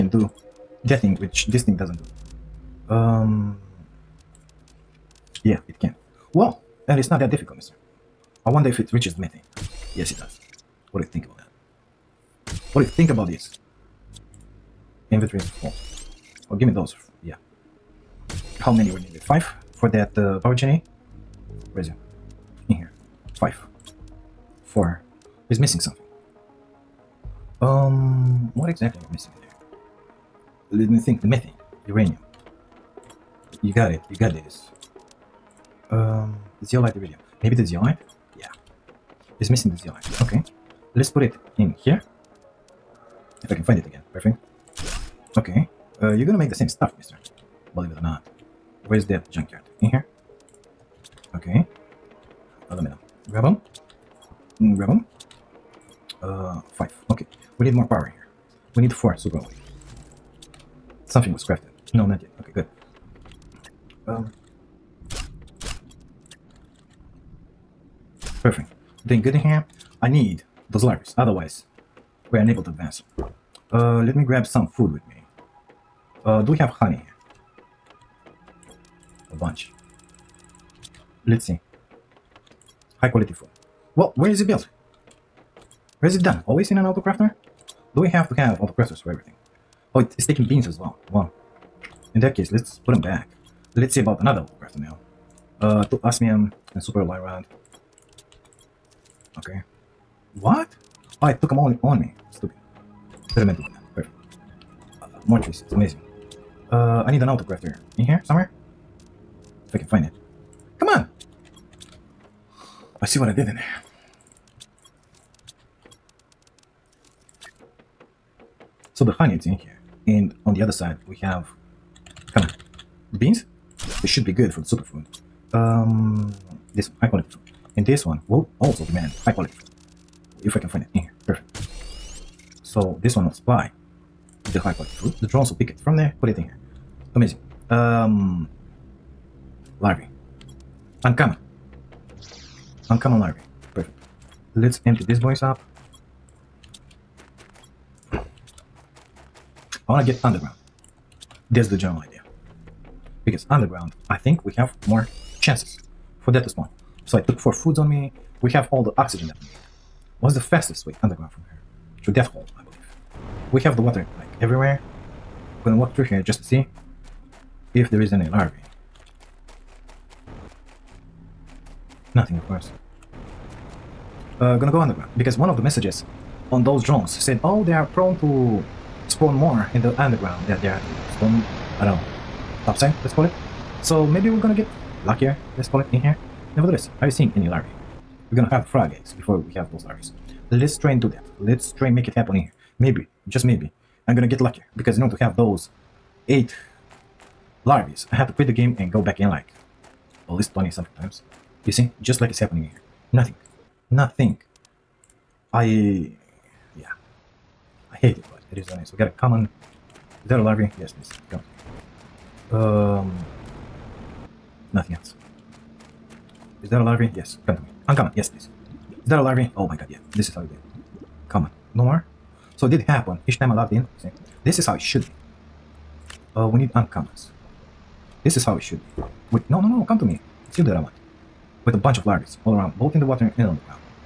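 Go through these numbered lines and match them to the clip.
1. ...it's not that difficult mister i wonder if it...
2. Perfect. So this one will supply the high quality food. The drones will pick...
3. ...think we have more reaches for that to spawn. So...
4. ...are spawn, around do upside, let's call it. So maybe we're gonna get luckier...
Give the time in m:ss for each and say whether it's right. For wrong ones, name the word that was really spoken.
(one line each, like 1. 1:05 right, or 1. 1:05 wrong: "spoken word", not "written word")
1. 0:06 right
2. 2:11 right
3. 2:34 wrong: "chances", not "reaches"
4. 3:00 right.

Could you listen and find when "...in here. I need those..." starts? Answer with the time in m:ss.
1:09.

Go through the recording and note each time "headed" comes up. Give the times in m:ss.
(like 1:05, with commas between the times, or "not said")
not said.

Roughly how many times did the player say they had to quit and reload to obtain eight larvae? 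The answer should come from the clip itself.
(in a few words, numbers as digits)
20 something.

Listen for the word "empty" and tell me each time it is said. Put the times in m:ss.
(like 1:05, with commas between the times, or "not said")
2:24.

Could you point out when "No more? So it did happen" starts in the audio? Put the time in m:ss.
3:41.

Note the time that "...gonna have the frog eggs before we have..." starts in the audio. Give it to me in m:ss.
3:08.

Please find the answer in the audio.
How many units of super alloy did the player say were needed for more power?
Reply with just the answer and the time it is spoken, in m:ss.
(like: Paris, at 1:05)
4, at 0:58.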